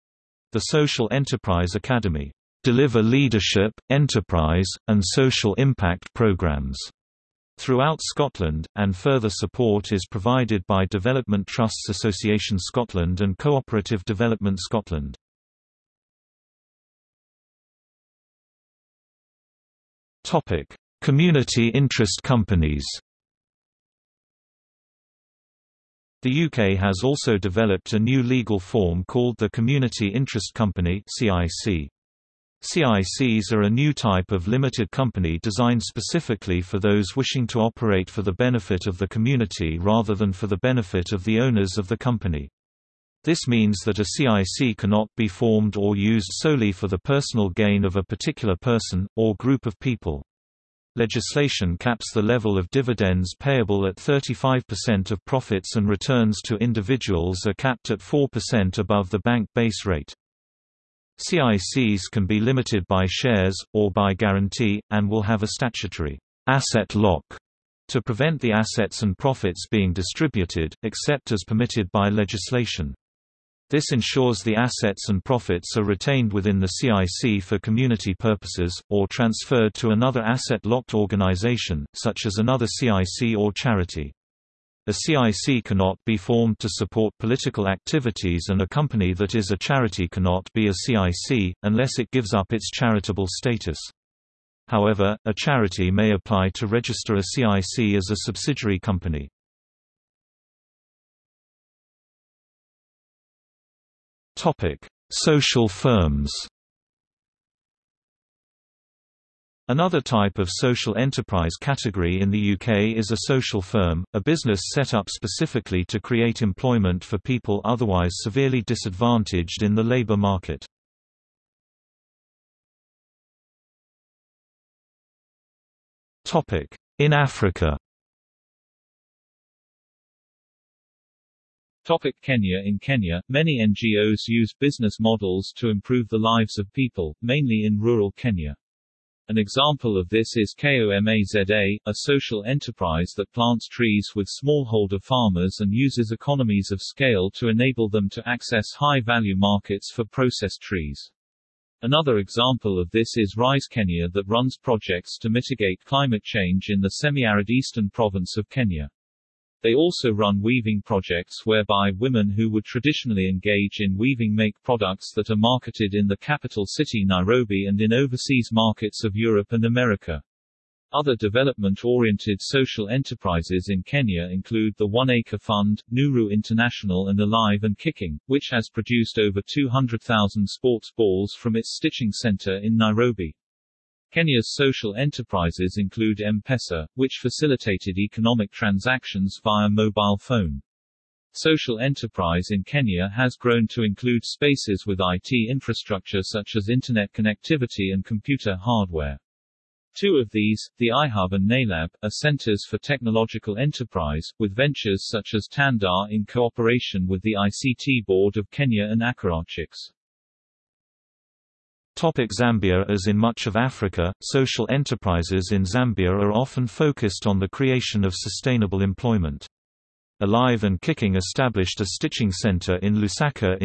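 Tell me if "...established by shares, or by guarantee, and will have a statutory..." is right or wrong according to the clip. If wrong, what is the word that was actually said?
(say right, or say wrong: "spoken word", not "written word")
wrong: "limited", not "established".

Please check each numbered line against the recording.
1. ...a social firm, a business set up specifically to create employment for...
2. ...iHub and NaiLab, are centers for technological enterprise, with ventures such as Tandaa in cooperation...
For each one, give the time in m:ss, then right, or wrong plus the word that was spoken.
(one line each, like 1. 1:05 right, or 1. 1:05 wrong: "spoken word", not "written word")
1. 1:53 right
2. 3:20 right.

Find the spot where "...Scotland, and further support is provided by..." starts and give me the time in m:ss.
0:08.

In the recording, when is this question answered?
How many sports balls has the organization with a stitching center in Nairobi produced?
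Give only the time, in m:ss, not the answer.
2:59.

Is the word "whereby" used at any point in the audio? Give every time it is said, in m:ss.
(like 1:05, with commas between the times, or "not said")
2:41.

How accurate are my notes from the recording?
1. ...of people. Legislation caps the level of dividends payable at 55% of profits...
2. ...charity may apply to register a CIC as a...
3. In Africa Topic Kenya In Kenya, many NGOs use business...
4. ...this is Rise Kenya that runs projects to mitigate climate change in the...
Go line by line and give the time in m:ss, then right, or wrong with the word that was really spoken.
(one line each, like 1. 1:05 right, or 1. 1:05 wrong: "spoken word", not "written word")
1. 0:49 wrong: "35", not "55"
2. 1:35 right
3. 2:06 right
4. 2:32 right.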